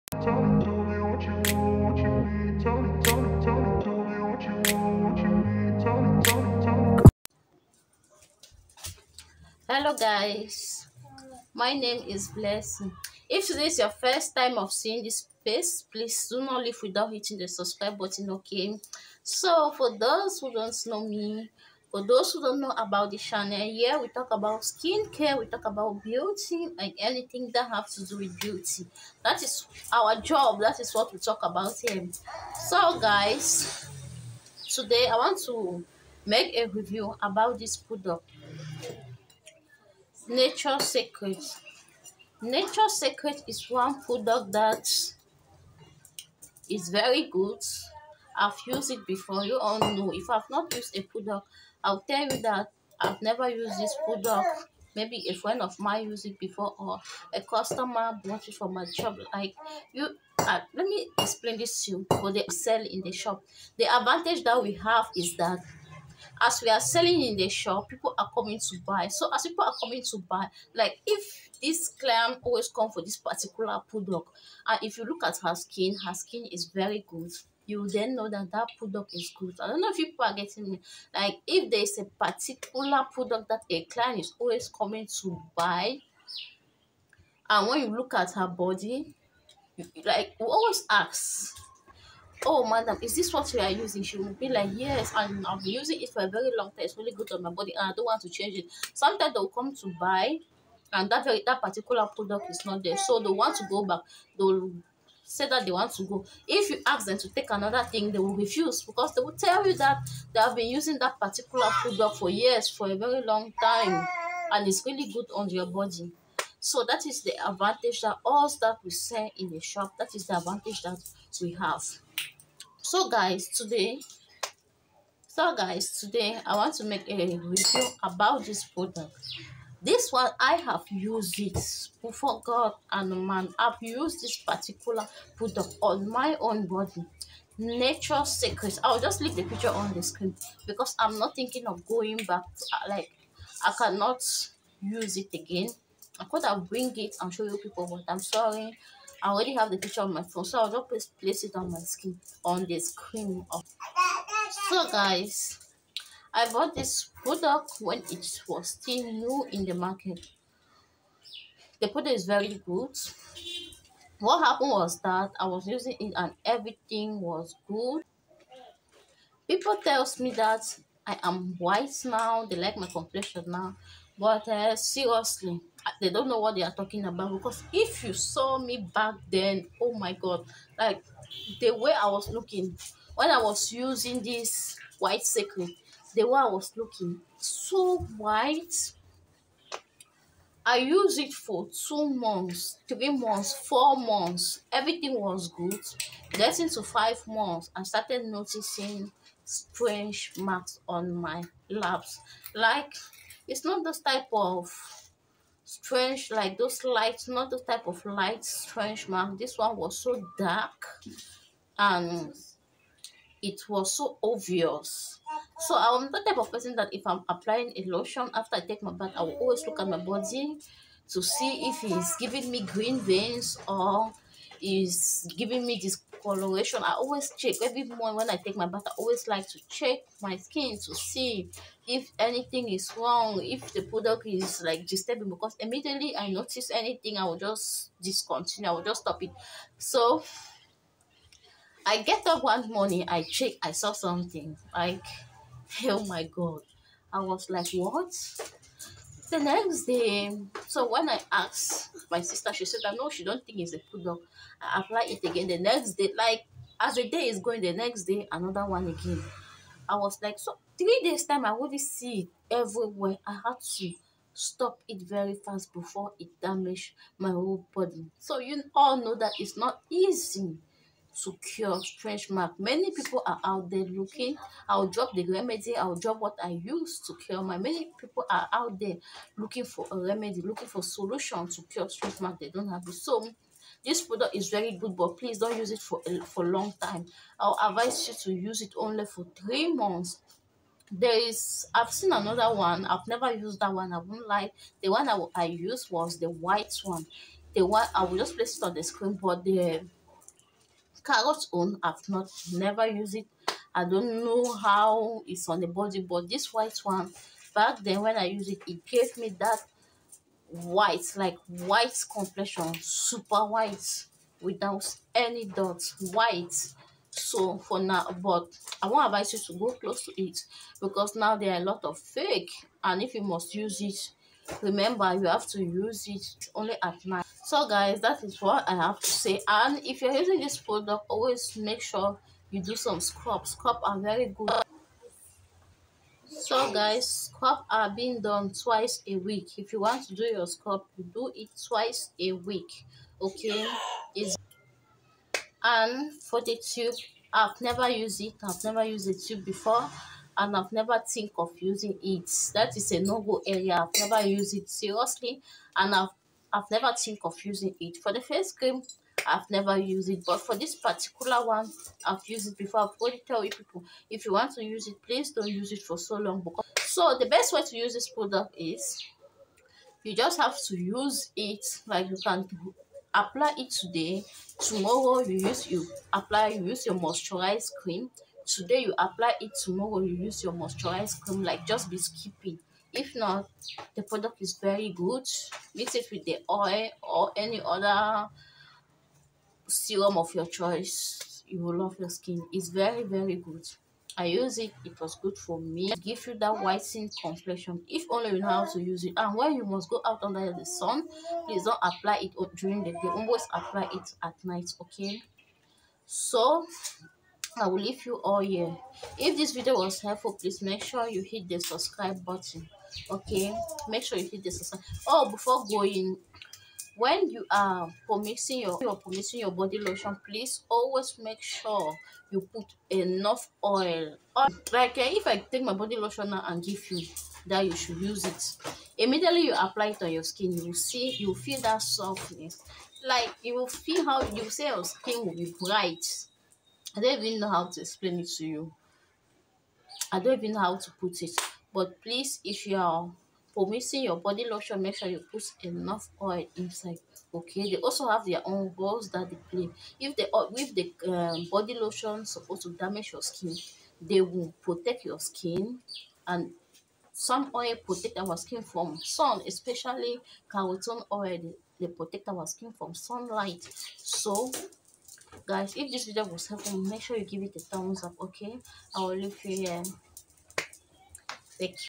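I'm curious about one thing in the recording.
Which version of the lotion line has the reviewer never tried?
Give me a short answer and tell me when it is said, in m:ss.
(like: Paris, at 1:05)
Carrot, at 5:01.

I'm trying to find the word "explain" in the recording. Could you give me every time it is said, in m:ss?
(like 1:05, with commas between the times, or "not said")
1:01, 7:17.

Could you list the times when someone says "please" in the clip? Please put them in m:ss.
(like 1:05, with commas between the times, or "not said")
0:15, 4:45, 6:05, 6:41, 6:50, 7:00, 7:22.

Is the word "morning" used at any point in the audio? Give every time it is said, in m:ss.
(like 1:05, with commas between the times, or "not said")
3:47, 4:02.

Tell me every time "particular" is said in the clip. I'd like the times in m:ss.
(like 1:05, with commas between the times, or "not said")
1:13, 1:22, 1:41, 1:51, 2:14, 6:00.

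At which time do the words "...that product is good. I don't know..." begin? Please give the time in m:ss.
1:18.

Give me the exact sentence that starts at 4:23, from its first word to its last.
I had to stop it very fast before it damaged my whole body.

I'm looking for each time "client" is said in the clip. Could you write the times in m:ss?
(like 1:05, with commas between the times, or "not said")
1:11, 1:23.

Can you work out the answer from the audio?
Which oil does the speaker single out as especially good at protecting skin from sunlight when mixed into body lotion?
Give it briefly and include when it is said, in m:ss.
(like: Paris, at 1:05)
Carotene oil, at 7:40.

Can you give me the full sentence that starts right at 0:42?
Nature Secret is one product that is very good.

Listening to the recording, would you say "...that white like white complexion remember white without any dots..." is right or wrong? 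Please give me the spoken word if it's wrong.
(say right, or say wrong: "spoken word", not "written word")
wrong: "super", not "remember".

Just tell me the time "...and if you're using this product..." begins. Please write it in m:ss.
5:29.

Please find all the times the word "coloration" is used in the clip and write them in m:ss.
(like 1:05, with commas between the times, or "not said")
3:46.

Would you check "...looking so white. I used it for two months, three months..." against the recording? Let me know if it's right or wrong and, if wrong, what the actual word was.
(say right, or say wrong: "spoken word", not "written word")
right.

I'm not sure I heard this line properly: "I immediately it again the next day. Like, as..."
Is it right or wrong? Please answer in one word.
wrong.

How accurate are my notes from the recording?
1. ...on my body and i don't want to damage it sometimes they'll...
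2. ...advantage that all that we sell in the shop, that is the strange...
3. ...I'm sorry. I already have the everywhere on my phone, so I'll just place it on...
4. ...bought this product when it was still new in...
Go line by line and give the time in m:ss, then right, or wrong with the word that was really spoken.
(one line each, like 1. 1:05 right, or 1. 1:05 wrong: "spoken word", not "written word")
1. 1:37 wrong: "change", not "damage"
2. 1:57 wrong: "advantage", not "strange"
3. 2:28 wrong: "picture", not "everywhere"
4. 2:36 right.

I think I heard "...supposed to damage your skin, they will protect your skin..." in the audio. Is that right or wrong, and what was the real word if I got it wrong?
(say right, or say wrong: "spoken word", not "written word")
right.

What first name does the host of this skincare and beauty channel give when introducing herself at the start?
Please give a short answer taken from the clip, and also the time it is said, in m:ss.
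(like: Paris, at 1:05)
Blessing, at 0:12.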